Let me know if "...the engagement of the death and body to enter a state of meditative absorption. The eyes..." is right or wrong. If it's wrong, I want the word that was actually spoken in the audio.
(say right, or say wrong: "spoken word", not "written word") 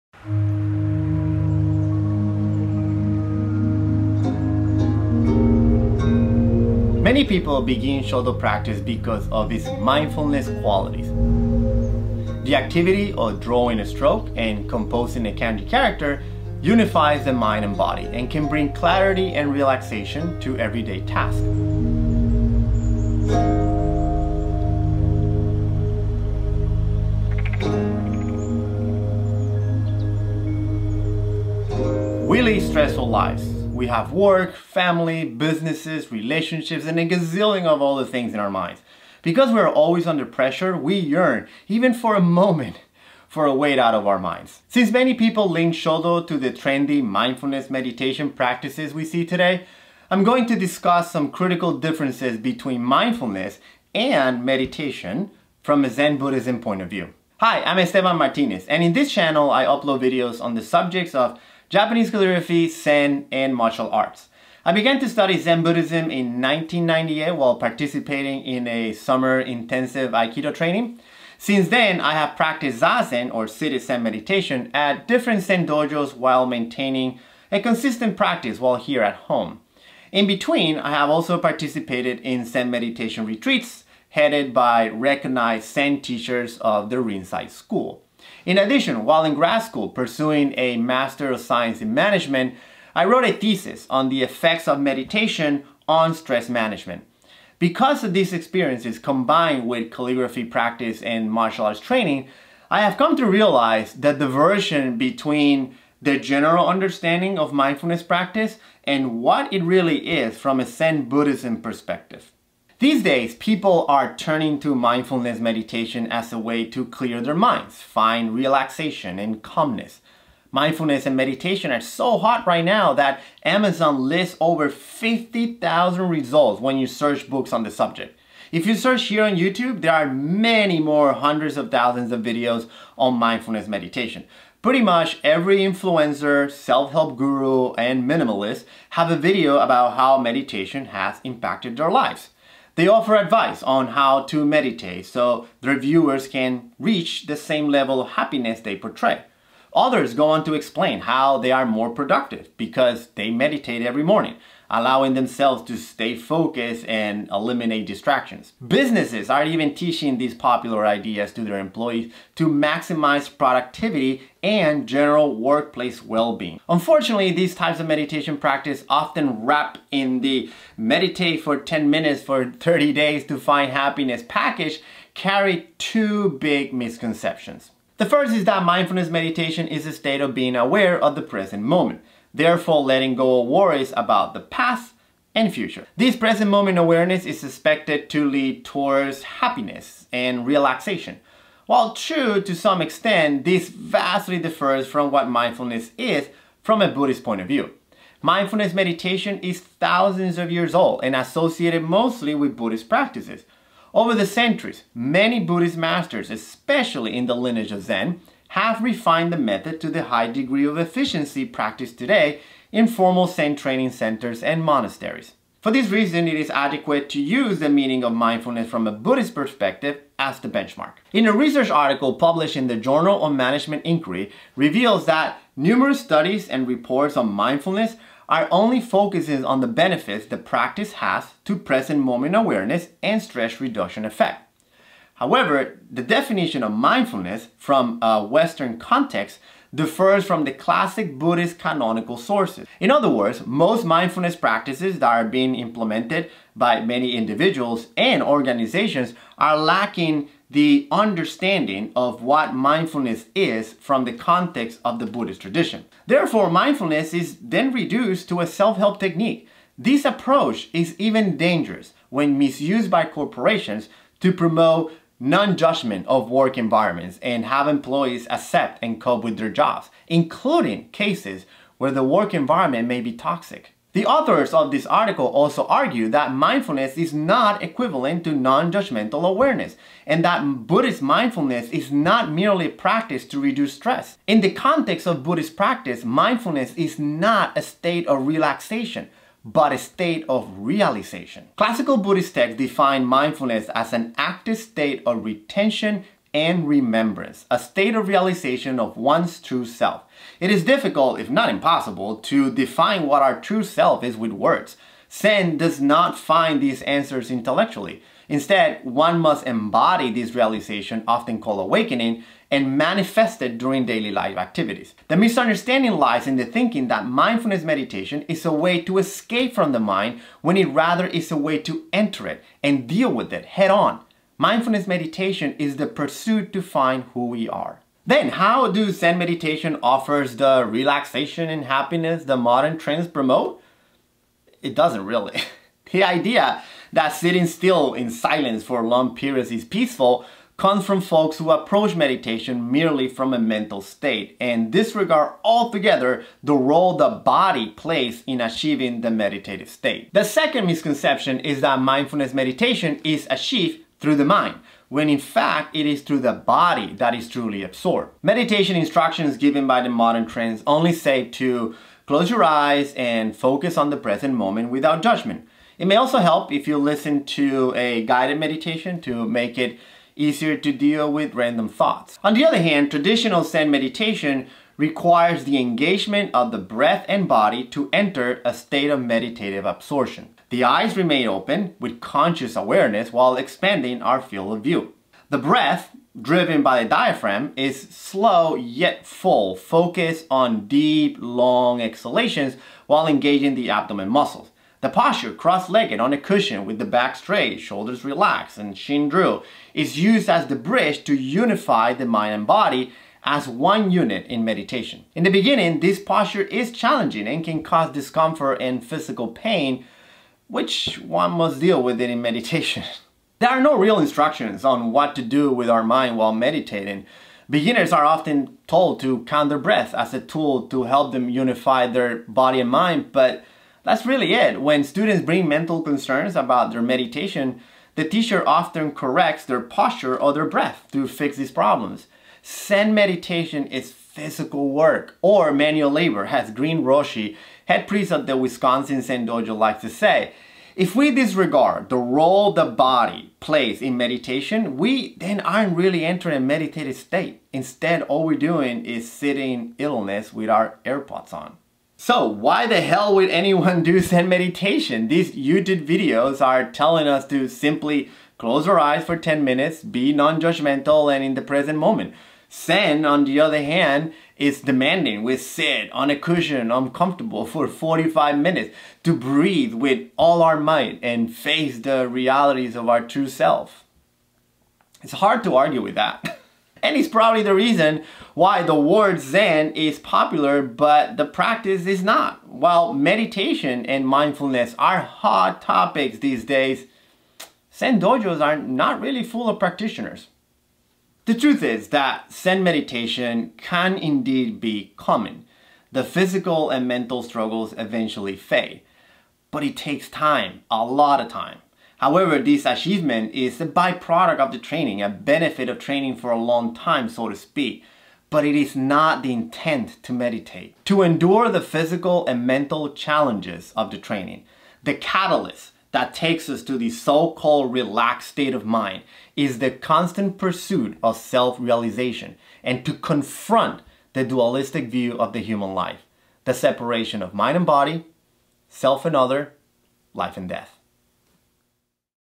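wrong: "breath", not "death".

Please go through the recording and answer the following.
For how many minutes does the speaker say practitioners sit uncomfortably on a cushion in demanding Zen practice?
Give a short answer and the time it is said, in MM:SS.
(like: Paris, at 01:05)
45, at 07:47.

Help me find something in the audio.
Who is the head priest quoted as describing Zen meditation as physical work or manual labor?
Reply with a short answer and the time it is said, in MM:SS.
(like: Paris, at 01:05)
Green Roshi, at 07:16.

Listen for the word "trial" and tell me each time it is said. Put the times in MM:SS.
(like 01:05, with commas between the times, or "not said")
not said.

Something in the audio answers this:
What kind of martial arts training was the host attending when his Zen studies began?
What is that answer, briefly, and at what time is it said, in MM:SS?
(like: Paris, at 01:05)
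summer intensive Aikido training, at 01:08.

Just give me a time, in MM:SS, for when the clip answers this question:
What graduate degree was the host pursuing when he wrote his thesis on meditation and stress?
01:30.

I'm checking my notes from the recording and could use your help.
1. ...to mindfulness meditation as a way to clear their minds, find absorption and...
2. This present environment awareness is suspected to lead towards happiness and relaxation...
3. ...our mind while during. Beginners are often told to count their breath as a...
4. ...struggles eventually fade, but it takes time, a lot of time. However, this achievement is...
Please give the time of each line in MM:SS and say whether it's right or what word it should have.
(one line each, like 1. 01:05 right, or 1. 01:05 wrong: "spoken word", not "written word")
1. 01:54 wrong: "relaxation", not "absorption"
2. 03:05 wrong: "moment", not "environment"
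3. 06:55 wrong: "meditating", not "during"
4. 08:17 right.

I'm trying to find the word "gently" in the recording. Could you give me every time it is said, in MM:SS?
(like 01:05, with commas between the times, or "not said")
not said.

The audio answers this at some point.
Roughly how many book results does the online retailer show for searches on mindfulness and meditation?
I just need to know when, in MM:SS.
02:04.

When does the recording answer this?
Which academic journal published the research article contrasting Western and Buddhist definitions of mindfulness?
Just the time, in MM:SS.
03:42.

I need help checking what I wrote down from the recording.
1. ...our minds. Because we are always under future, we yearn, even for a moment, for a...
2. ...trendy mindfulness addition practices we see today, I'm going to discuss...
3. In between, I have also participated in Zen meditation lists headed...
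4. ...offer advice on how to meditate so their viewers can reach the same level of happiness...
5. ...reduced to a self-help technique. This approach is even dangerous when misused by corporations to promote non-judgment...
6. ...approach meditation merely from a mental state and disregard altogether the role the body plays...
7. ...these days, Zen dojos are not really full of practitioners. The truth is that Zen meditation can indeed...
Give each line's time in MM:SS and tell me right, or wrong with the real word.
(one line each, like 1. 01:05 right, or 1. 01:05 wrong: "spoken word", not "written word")
1. 00:38 wrong: "pressure", not "future"
2. 00:46 wrong: "meditation", not "addition"
3. 01:20 wrong: "retreats", not "lists"
4. 02:22 right
5. 04:17 right
6. 05:41 right
7. 08:06 right.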